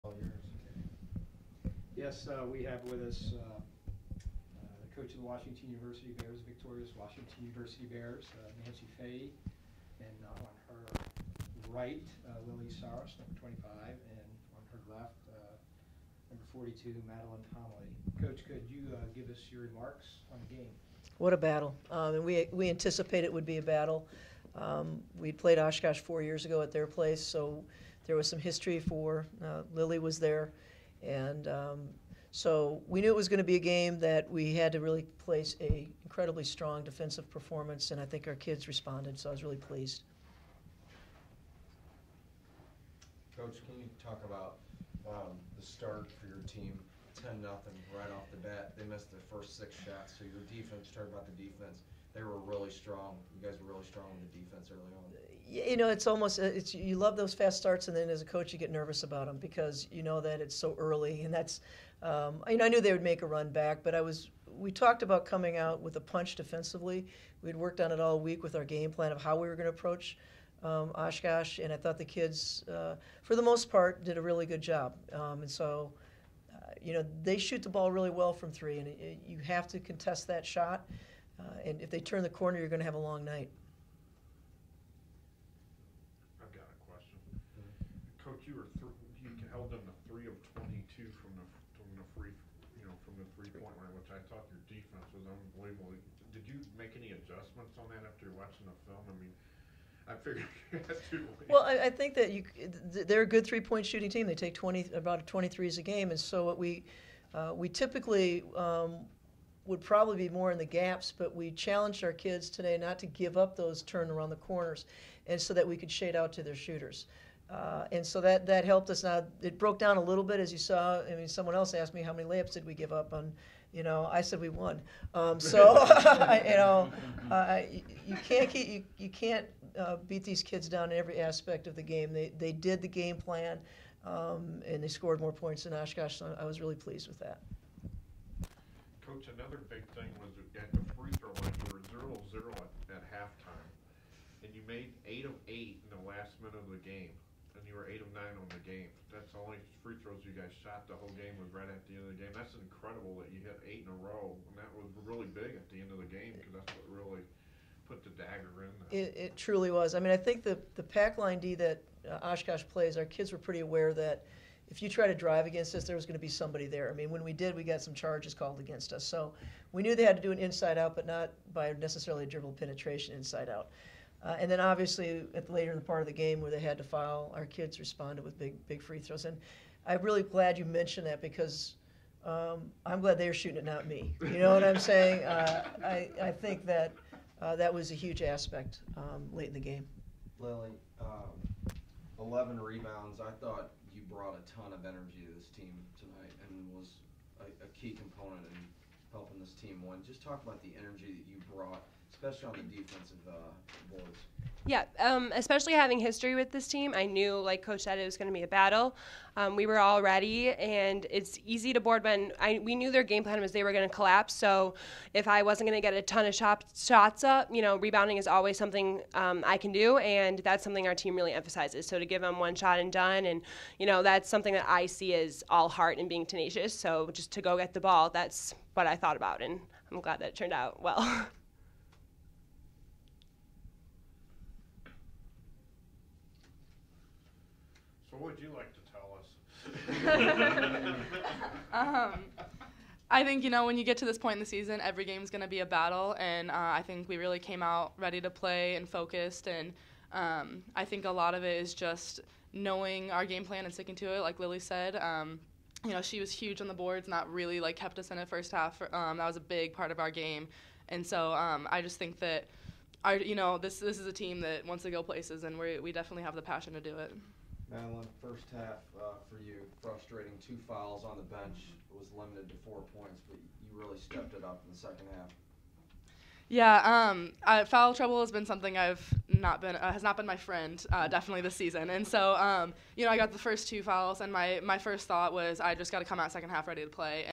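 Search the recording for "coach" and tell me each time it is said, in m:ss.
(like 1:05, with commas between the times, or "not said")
0:04, 0:18, 0:43, 0:58, 2:19, 3:27.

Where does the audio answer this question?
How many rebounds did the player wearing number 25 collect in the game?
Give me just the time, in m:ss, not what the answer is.
3:12.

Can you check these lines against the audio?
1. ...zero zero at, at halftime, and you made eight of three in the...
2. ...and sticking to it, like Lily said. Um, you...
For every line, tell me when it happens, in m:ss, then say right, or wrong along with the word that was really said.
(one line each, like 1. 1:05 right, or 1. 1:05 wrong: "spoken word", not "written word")
1. 2:21 wrong: "eight", not "three"
2. 4:13 right.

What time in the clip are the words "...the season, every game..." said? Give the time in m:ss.
4:04.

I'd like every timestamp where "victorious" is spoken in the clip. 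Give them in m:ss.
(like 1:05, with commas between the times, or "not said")
0:06.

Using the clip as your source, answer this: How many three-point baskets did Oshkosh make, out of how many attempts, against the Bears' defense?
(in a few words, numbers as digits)
3 of 22.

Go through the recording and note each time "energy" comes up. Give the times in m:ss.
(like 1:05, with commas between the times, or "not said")
3:14, 3:20.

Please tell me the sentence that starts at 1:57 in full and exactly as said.
Uh, and so that, that helped us.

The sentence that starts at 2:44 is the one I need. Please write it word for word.
If you try to drive against us, there was going to be somebody there.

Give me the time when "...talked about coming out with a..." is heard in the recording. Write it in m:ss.
1:04.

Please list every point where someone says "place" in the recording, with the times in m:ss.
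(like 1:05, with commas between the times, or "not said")
0:26, 0:35, 4:25.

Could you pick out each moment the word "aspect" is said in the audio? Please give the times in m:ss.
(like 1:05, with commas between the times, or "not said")
2:11, 3:08.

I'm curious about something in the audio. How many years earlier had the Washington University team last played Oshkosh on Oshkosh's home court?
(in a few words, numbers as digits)
4.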